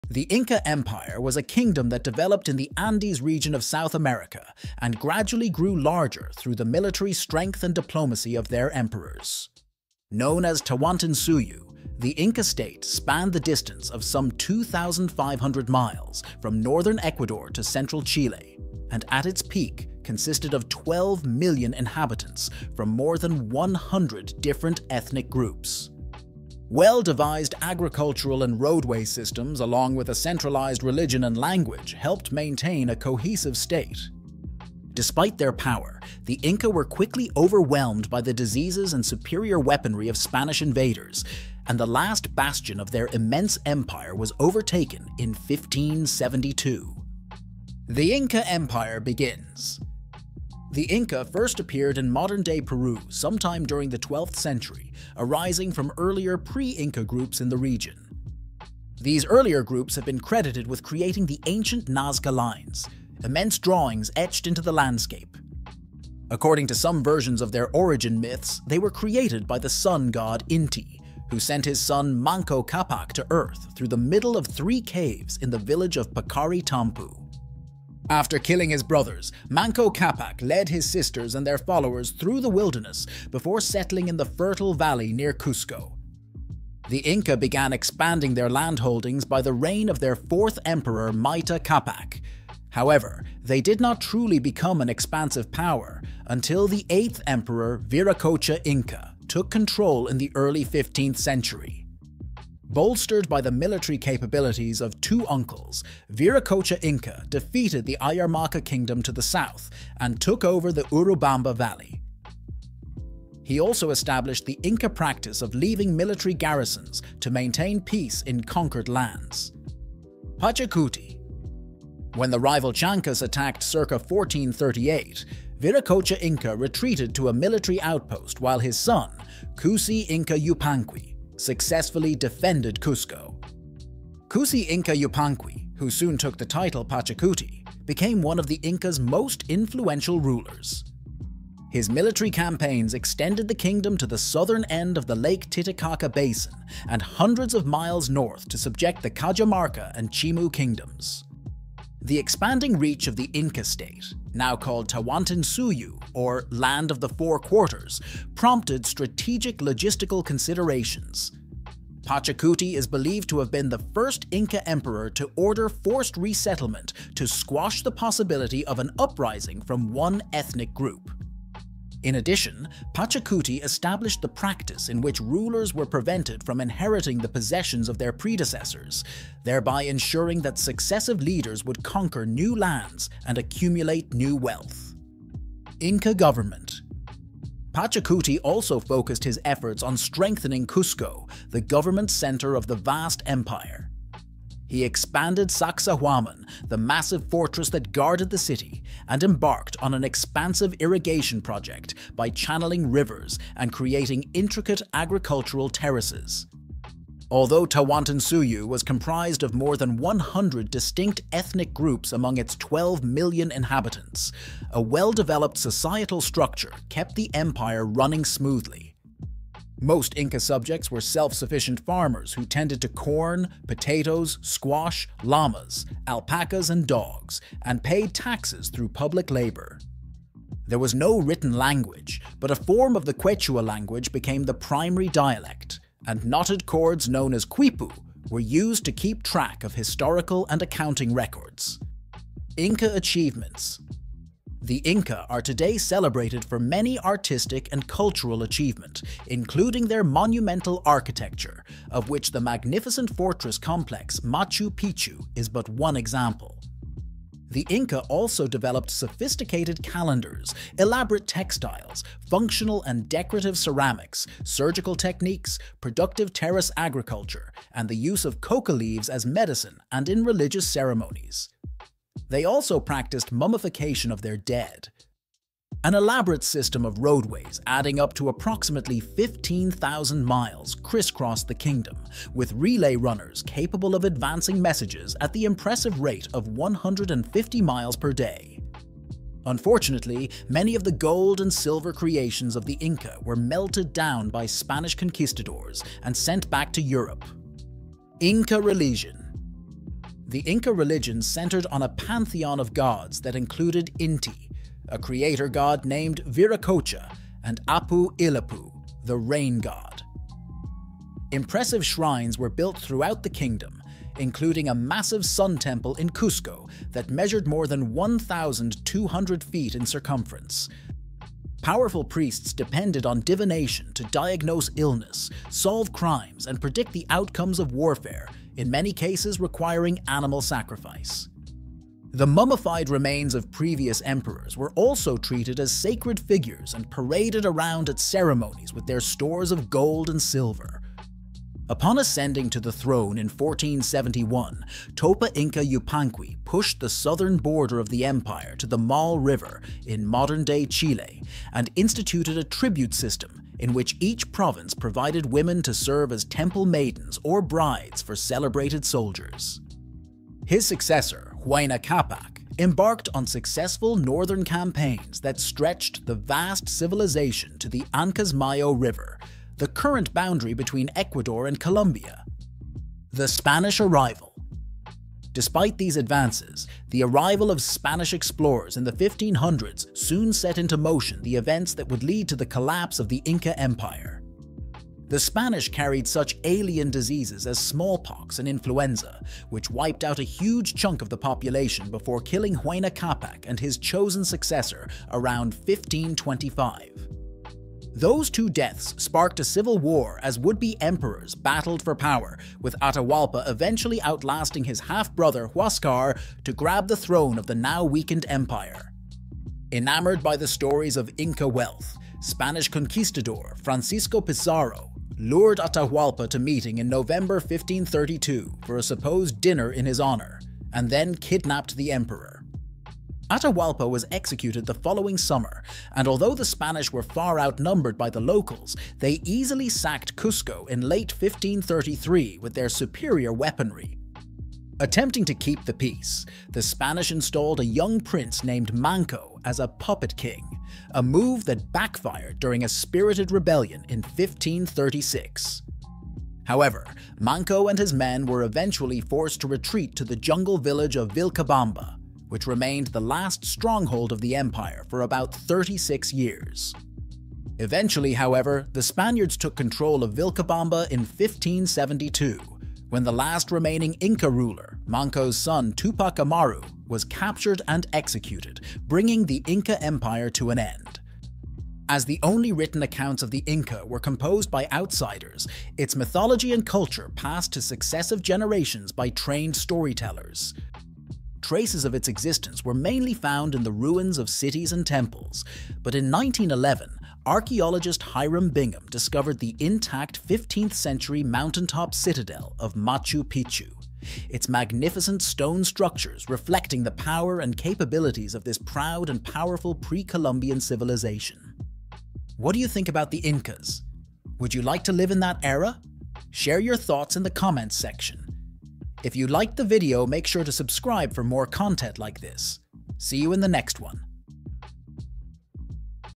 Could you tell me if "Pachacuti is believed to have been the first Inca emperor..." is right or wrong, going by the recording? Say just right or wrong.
right.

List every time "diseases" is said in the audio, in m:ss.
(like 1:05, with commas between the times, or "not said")
0:38, 6:26.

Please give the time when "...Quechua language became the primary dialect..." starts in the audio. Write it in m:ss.
3:53.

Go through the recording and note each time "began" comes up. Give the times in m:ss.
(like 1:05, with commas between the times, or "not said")
1:27.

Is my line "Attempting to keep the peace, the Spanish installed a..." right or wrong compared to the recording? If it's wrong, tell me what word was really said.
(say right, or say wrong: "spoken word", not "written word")
right.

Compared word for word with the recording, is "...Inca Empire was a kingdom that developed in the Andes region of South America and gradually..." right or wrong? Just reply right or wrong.
right.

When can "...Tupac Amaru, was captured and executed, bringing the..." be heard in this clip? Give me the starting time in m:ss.
7:45.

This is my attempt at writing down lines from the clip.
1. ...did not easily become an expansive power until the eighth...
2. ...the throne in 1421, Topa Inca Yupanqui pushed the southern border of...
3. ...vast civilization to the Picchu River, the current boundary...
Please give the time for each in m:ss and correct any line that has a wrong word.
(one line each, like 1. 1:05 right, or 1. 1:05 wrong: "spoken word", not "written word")
1. 1:33 wrong: "truly", not "easily"
2. 5:42 wrong: "1471", not "1421"
3. 6:06 wrong: "Ancasmayo", not "Picchu".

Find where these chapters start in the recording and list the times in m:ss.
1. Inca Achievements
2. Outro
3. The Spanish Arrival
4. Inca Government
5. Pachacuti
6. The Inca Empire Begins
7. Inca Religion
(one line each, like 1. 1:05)
1. 4:03
2. 8:23
3. 6:14
4. 3:06
5. 2:00
6. 0:48
7. 4:59.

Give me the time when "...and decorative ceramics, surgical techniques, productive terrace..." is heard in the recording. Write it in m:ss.
4:22.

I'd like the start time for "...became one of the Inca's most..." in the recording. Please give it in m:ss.
2:17.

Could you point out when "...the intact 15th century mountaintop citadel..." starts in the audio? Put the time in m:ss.
8:09.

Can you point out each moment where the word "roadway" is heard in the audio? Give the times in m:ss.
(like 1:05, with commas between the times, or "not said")
0:28, 4:36.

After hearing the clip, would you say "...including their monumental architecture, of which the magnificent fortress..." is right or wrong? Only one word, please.
right.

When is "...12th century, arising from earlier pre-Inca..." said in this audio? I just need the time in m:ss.
0:53.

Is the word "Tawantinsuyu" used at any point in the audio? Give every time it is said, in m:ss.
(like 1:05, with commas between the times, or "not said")
0:10, 2:34, 3:27.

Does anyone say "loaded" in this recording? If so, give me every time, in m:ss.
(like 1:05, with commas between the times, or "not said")
not said.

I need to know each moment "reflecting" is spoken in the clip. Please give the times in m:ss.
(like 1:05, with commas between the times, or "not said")
8:16.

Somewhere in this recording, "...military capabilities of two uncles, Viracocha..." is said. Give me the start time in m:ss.
1:43.